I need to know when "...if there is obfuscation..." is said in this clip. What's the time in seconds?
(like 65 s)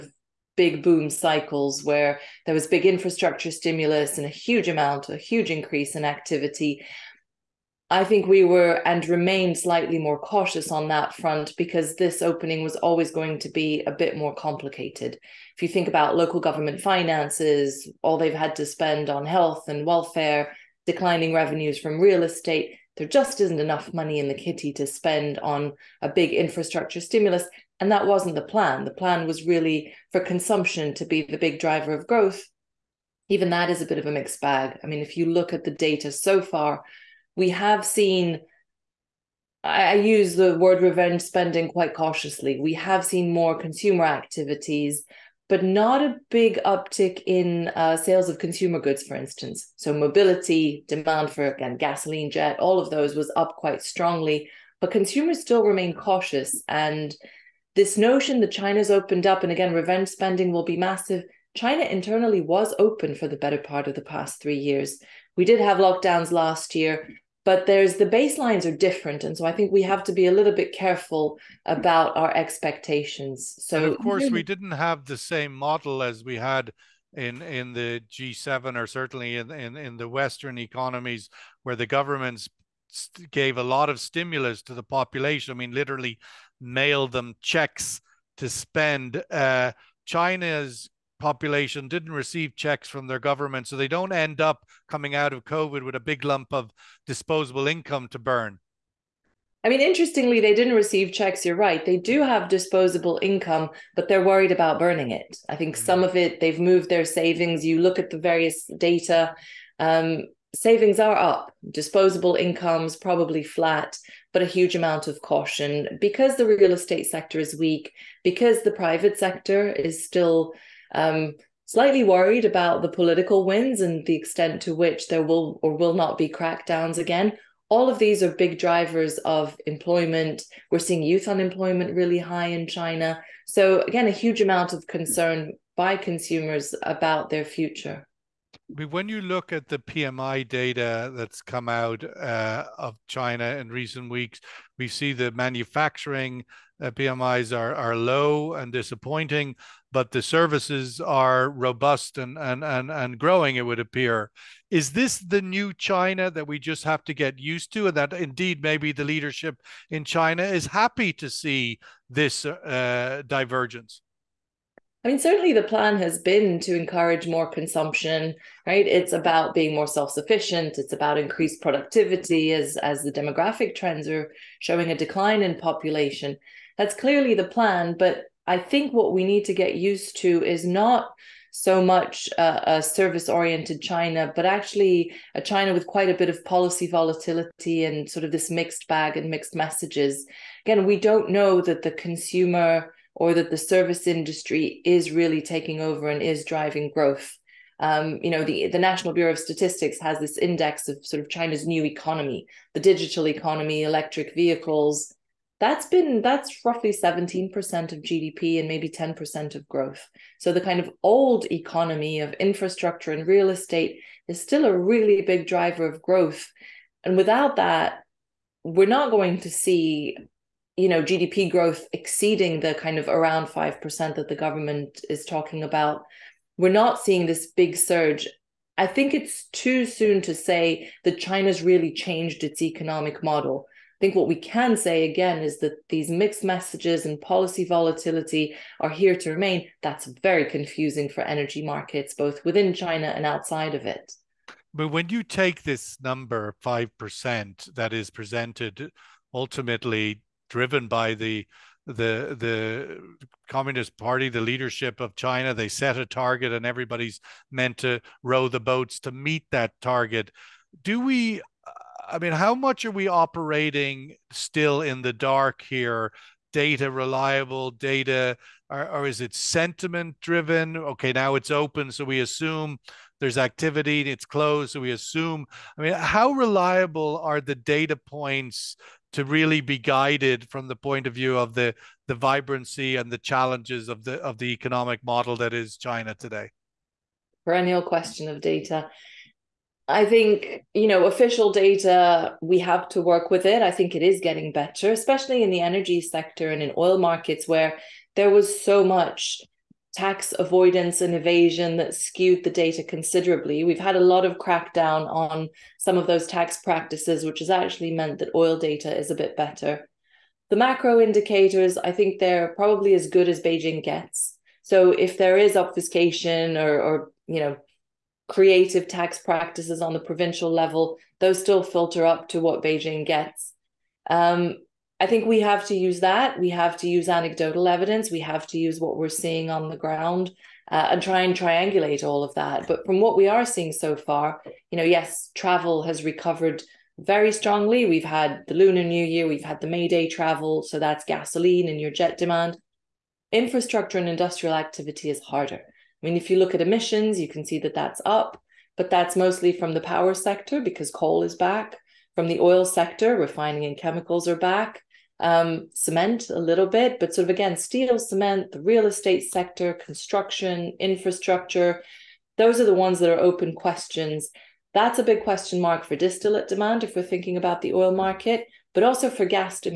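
314 s.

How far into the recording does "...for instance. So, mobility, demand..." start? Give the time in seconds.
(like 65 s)
49 s.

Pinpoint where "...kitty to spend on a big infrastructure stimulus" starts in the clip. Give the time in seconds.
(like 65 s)
24 s.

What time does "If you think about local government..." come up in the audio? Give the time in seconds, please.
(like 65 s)
15 s.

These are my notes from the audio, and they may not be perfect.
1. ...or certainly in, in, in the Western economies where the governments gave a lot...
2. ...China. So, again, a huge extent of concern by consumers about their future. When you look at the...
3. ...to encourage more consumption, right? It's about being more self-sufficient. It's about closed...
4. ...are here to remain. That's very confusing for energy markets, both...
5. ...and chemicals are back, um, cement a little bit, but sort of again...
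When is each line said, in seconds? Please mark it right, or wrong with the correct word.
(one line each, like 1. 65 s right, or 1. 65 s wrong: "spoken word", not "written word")
1. 78 s right
2. 132 s wrong: "amount", not "extent"
3. 166 s wrong: "increased", not "closed"
4. 238 s right
5. 353 s right.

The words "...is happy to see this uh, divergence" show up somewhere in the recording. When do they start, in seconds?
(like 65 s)
160 s.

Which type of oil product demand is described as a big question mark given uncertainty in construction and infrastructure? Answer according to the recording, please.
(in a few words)
distillate.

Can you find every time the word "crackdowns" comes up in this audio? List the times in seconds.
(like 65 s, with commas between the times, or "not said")
126 s, 304 s.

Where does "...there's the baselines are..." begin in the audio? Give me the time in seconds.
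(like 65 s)
67 s.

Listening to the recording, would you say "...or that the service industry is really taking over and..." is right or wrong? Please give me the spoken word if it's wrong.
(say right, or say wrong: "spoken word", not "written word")
right.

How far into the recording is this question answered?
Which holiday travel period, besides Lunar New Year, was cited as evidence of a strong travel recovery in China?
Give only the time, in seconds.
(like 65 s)
339 s.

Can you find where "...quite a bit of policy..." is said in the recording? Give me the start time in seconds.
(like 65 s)
185 s.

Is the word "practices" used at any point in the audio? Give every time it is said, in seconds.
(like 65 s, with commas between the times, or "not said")
306 s, 319 s.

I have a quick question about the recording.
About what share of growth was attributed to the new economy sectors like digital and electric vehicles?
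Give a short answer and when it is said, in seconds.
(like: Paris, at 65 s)
10%, at 208 s.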